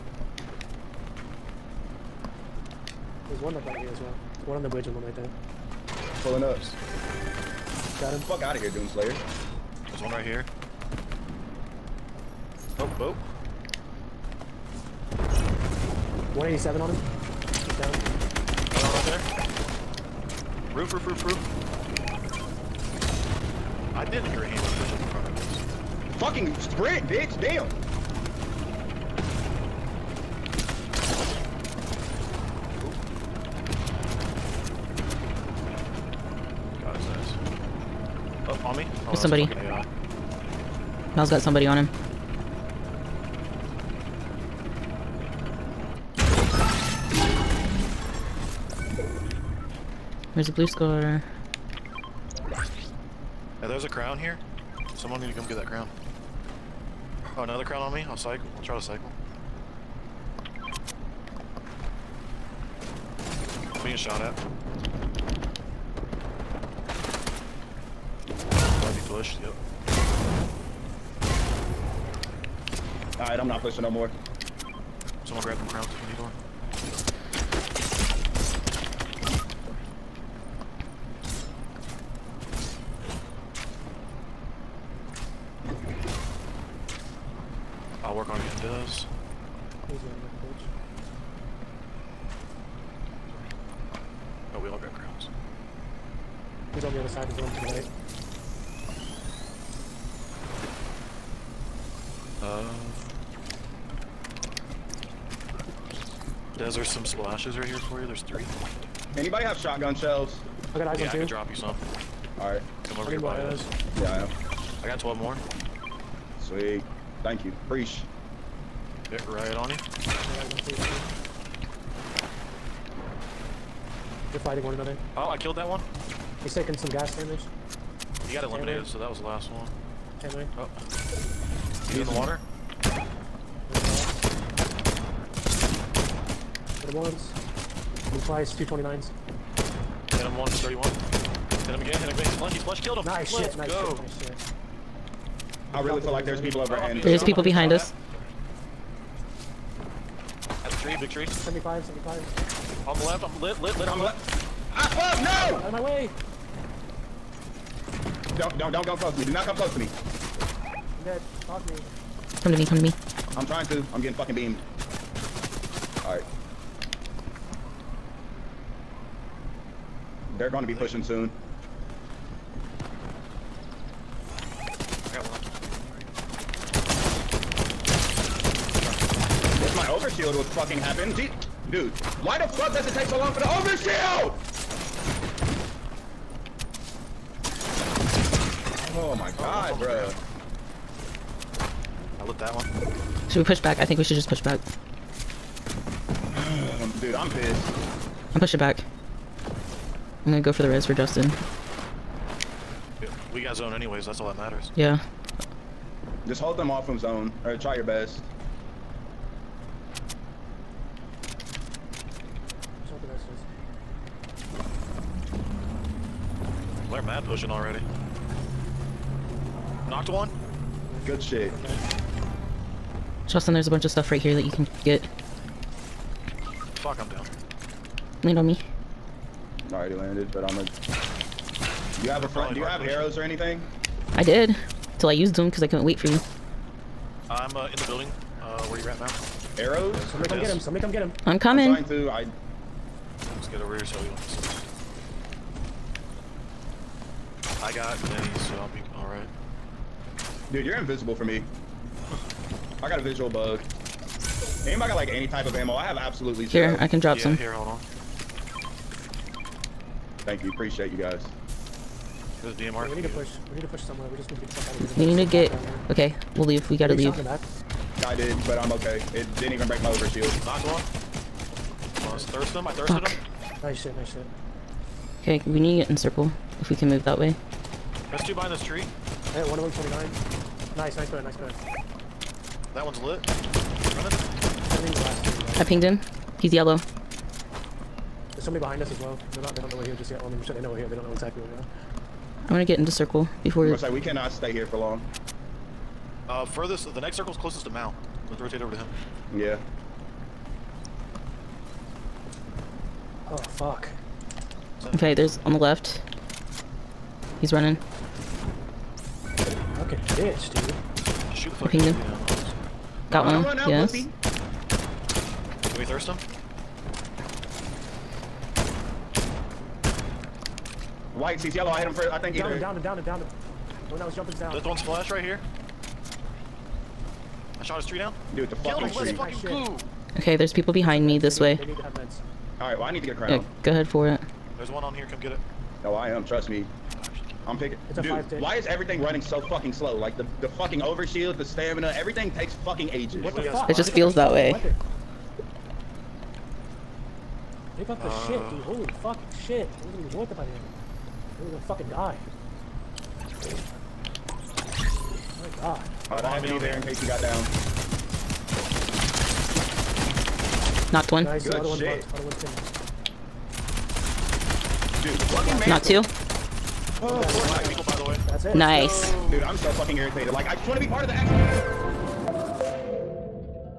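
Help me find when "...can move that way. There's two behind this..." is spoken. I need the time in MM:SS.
04:36.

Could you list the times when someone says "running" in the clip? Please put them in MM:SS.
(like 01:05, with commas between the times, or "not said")
05:07, 05:39.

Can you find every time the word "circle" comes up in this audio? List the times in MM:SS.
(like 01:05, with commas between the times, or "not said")
04:35, 04:52, 04:57.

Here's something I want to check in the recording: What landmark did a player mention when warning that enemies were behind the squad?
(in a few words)
big tree.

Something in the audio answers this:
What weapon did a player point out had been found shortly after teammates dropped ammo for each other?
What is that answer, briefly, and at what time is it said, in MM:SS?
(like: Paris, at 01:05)
DMR, at 04:22.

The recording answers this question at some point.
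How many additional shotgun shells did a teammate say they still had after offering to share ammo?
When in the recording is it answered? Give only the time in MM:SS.
01:54.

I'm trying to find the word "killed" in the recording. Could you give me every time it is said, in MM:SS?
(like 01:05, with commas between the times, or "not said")
02:05, 02:22.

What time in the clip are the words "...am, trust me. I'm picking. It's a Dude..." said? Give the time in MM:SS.
05:36.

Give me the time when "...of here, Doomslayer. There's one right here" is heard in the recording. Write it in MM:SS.
00:08.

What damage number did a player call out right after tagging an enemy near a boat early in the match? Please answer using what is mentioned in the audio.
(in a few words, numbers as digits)
187.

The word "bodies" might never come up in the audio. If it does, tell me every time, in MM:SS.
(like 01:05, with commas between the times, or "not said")
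not said.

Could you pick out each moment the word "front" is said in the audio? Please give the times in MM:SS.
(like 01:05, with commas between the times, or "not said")
00:25, 03:52.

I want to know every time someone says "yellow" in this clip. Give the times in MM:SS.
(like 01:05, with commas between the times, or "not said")
04:46, 05:21.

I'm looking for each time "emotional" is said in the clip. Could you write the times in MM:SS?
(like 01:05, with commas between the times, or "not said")
not said.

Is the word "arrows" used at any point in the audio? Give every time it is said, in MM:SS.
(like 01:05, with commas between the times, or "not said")
03:52, 03:59.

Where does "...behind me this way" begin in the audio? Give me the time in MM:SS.
05:30.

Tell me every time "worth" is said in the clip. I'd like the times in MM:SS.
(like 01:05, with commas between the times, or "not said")
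05:50.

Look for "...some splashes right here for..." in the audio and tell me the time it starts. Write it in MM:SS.
01:46.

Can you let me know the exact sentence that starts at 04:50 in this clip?
Well, I mean, I'm sure they know we're here.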